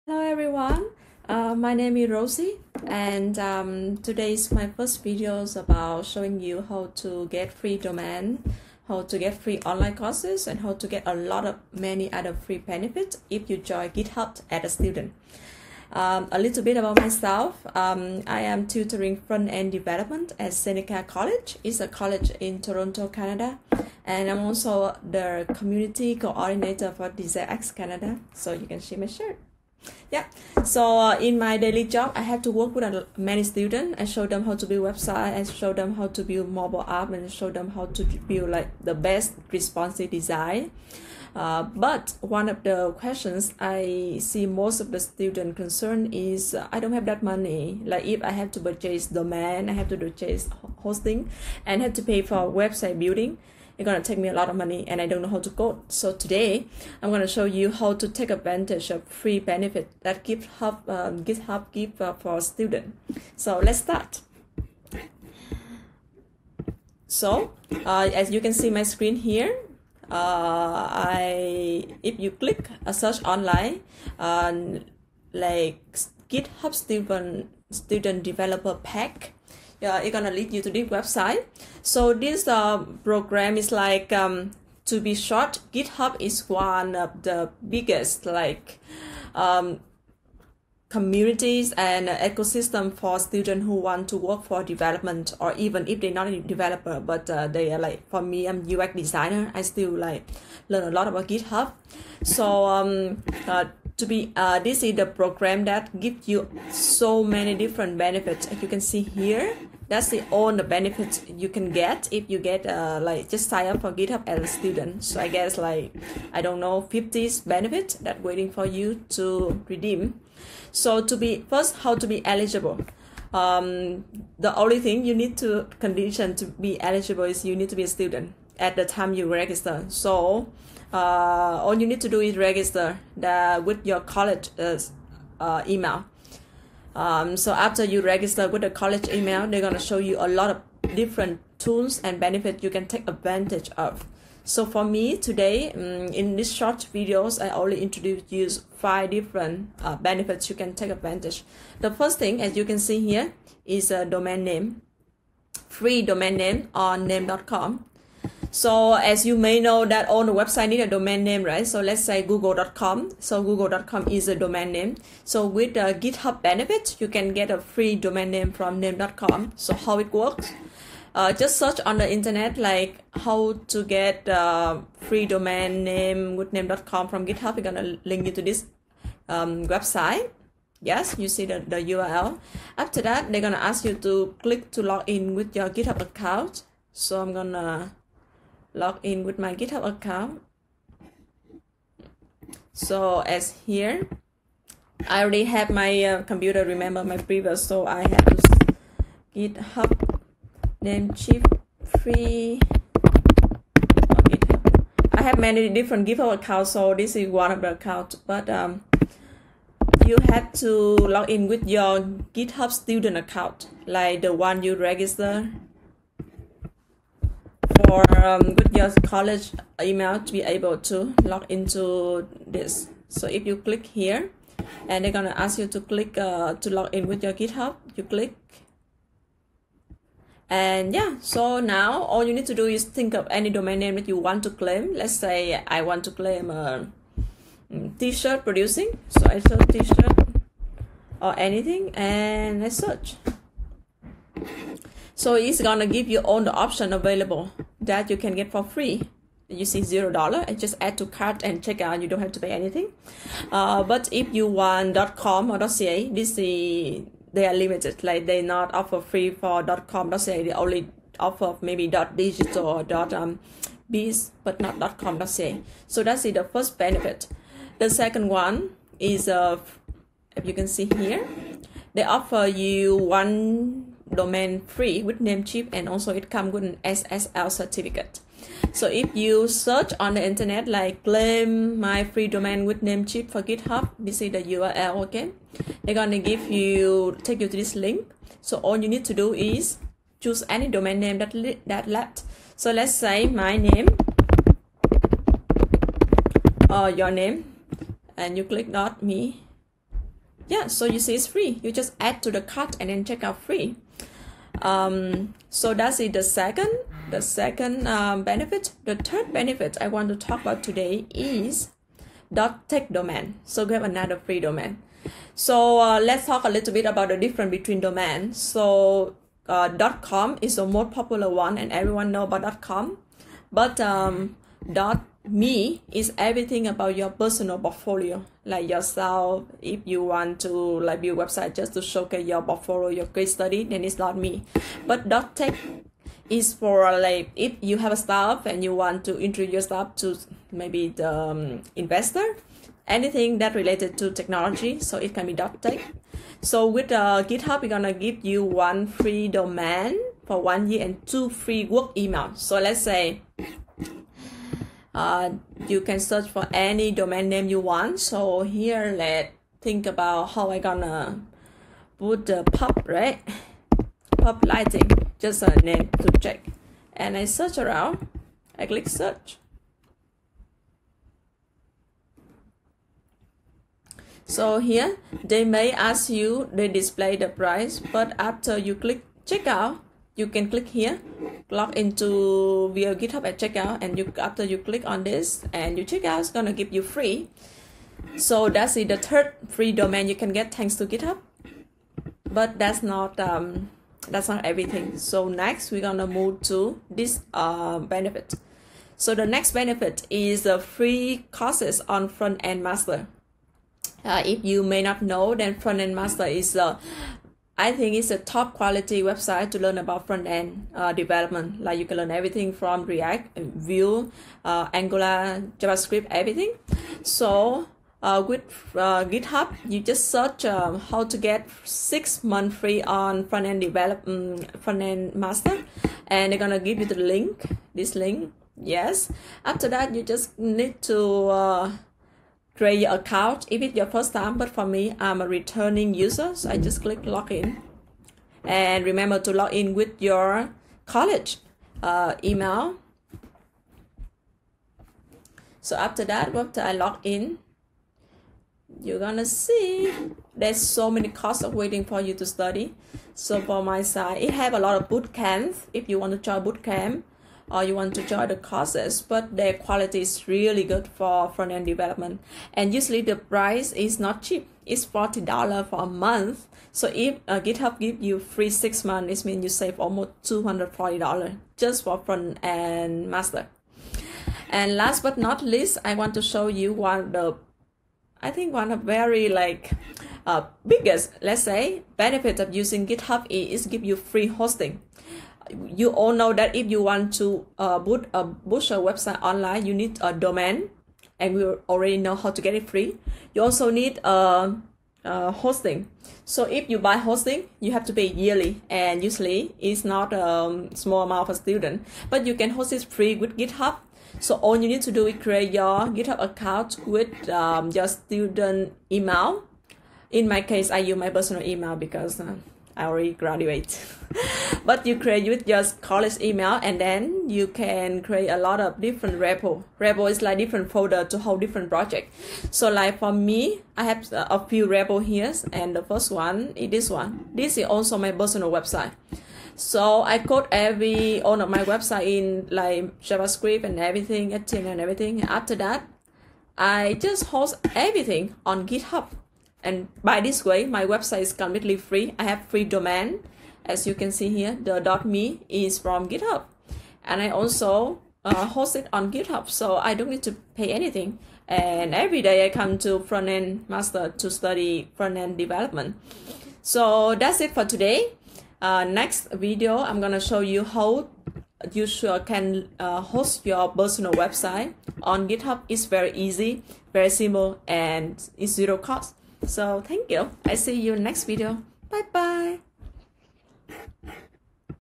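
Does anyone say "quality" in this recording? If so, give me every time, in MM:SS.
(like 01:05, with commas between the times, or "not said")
06:48, 07:39.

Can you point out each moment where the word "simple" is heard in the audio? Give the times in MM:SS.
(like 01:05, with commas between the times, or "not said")
09:27.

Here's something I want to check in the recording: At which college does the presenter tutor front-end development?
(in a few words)
Seneca College.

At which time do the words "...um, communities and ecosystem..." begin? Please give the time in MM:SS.
01:29.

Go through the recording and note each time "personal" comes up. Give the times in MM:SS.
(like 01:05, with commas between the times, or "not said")
05:27, 08:31, 08:48, 09:23.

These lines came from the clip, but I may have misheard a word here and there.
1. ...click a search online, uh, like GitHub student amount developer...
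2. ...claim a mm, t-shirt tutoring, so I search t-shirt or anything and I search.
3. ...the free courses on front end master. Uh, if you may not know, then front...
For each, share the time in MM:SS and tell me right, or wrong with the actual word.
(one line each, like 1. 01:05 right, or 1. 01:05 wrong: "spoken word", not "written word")
1. 01:12 wrong: "student", not "amount"
2. 03:56 wrong: "producing", not "tutoring"
3. 06:40 right.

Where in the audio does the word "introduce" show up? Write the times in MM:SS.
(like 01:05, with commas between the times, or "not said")
02:27, 05:39.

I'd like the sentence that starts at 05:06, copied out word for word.
The second, the second um, benefit.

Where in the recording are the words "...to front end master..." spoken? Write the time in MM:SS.
09:12.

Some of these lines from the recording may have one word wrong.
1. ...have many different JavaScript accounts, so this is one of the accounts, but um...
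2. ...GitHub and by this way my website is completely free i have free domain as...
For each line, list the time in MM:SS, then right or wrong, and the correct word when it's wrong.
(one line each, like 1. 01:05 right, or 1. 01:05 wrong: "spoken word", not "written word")
1. 03:25 wrong: "GitHub", not "JavaScript"
2. 08:58 right.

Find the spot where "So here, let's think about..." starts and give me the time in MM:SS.
05:57.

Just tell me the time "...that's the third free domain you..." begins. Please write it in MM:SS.
06:28.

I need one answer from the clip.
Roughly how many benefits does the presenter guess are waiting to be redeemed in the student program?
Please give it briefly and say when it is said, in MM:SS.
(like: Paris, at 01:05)
50, at 01:56.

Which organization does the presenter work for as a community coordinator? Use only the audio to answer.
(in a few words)
DesignX Canada.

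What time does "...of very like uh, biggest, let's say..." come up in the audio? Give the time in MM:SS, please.
07:58.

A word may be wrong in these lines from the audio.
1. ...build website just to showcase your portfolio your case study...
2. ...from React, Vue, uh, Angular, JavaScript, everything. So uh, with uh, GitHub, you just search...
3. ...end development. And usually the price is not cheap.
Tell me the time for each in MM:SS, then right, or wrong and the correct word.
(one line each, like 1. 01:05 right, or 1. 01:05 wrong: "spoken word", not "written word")
1. 05:31 right
2. 06:52 right
3. 07:41 right.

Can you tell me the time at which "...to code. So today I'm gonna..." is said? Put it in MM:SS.
00:55.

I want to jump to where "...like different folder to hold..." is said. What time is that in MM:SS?
08:40.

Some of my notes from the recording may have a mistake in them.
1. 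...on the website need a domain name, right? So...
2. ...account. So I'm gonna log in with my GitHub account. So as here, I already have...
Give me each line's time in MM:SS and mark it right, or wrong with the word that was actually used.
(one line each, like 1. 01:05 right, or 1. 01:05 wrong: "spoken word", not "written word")
1. 02:40 right
2. 03:06 right.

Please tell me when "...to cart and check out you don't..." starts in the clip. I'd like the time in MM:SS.
04:10.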